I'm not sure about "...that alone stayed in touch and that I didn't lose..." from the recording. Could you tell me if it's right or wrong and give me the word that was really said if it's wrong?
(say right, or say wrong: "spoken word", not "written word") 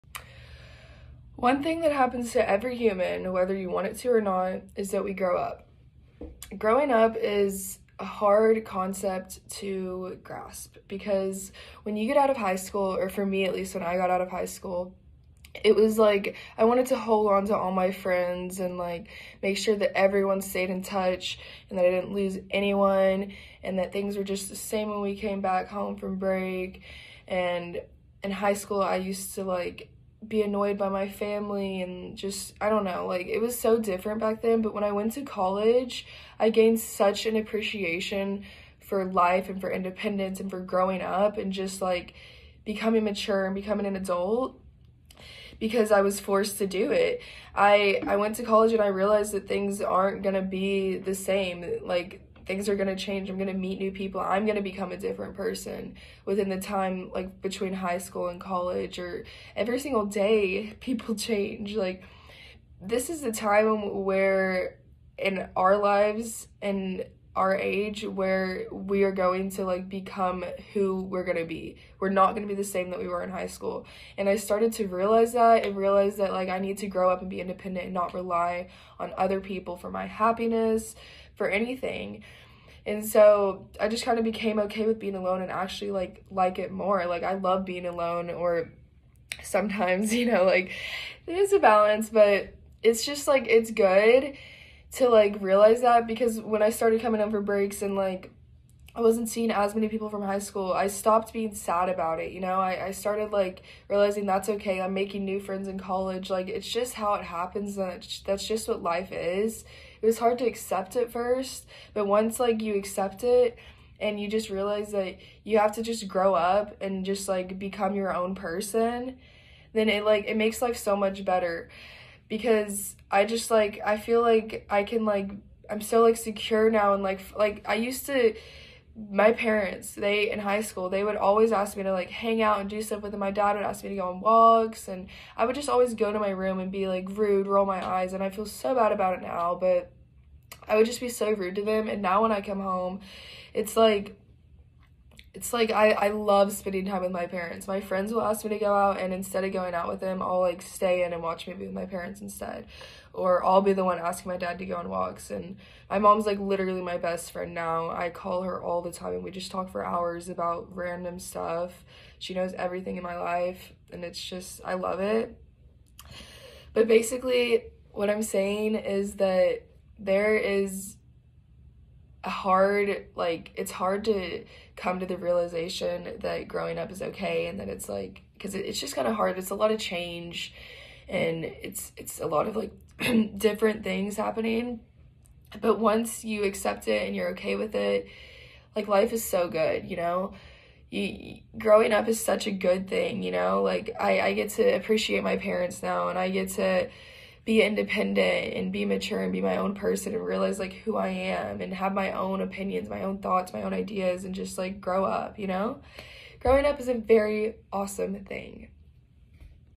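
wrong: "everyone", not "alone".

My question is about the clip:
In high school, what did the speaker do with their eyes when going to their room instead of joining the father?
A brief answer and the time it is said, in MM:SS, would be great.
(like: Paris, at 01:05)
roll my eyes, at 02:17.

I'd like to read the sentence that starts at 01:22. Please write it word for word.
And so I just kind of became okay with being alone and actually like like it more.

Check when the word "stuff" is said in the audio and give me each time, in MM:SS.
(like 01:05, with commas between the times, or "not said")
02:12, 02:41.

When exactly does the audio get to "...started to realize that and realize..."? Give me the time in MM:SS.
01:14.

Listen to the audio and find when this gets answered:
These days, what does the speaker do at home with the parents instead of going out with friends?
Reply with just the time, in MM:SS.
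02:31.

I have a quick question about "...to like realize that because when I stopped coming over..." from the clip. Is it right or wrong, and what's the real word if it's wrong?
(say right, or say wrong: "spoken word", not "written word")
wrong: "started", not "stopped".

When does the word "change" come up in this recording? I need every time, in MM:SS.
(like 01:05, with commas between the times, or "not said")
00:53, 01:01, 02:59.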